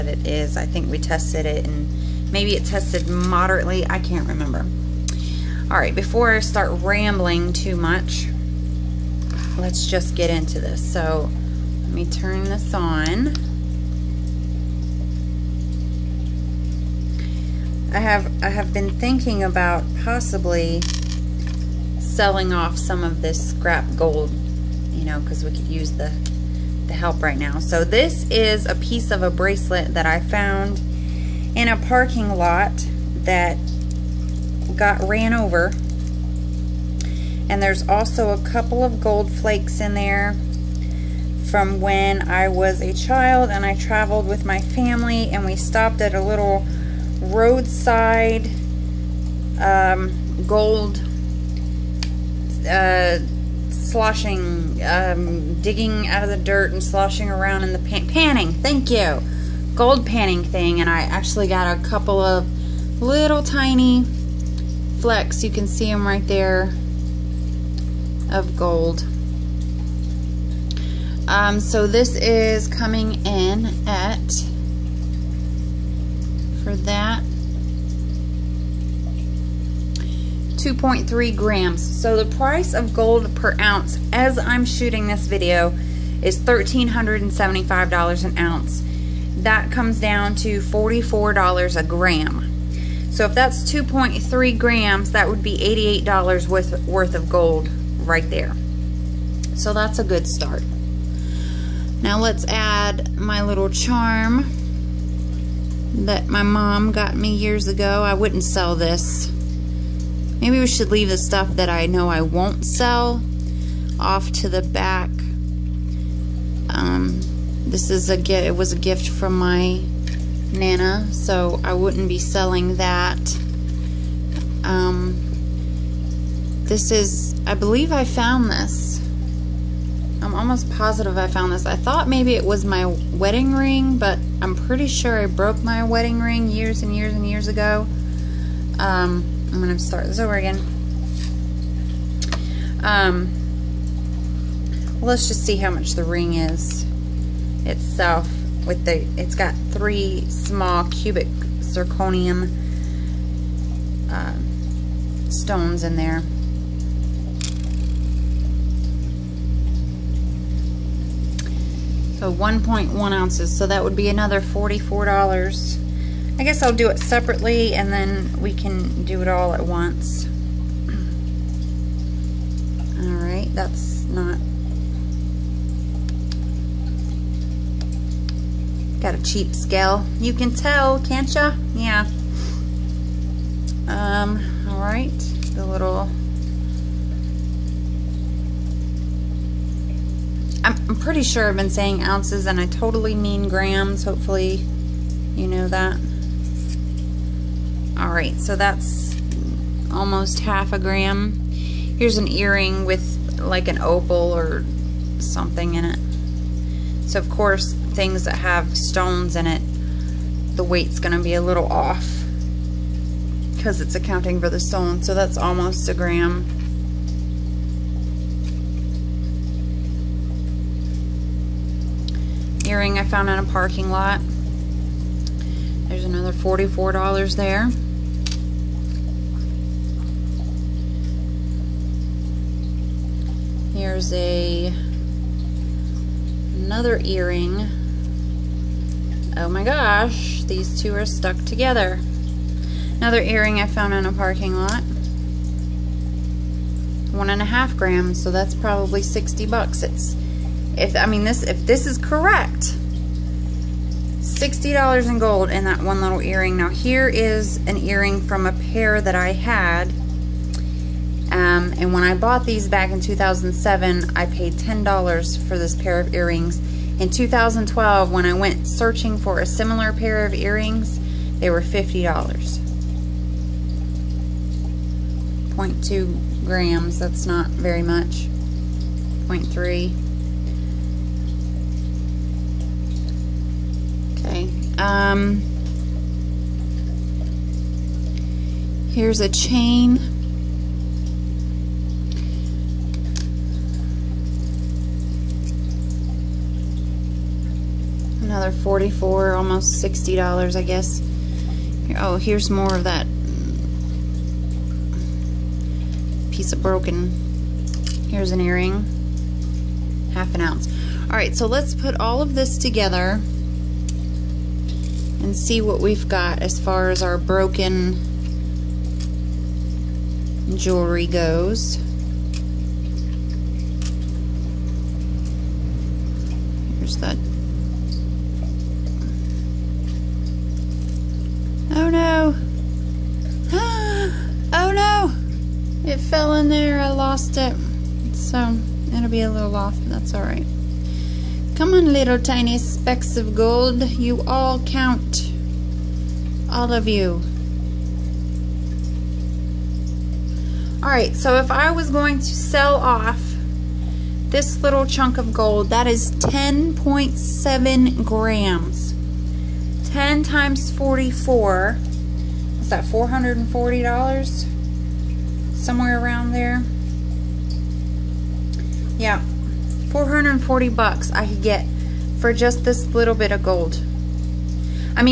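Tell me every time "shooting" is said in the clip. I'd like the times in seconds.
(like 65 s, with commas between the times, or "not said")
84 s.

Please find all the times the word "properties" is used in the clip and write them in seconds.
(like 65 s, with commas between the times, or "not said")
not said.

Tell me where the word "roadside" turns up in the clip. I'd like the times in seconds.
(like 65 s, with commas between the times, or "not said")
47 s.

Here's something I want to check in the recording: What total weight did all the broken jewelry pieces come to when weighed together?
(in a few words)
10.7 grams.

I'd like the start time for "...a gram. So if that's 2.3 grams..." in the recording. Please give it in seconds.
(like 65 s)
91 s.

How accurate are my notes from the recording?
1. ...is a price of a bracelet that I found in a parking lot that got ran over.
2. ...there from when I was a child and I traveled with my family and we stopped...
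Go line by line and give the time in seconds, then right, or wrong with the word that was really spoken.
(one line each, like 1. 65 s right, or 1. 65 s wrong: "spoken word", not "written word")
1. 28 s wrong: "piece", not "price"
2. 39 s right.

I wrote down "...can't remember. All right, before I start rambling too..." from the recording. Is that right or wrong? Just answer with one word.
right.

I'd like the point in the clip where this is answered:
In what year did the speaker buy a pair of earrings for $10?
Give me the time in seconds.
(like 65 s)
263 s.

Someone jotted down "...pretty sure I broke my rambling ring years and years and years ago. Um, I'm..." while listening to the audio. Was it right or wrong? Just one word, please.
wrong.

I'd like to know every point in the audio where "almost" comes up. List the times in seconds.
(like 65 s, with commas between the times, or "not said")
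130 s, 199 s, 215 s, 299 s.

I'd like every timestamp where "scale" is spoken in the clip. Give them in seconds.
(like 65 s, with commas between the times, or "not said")
179 s.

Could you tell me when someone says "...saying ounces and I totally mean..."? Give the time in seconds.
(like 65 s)
191 s.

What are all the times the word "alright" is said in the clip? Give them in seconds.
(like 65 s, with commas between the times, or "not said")
340 s, 350 s.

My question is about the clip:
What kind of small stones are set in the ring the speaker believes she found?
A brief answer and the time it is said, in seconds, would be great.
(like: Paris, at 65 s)
cubic zirconium, at 150 s.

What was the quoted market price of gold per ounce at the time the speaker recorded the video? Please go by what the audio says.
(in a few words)
$1,375.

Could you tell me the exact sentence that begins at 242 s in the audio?
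Another earring I found in a parking lot.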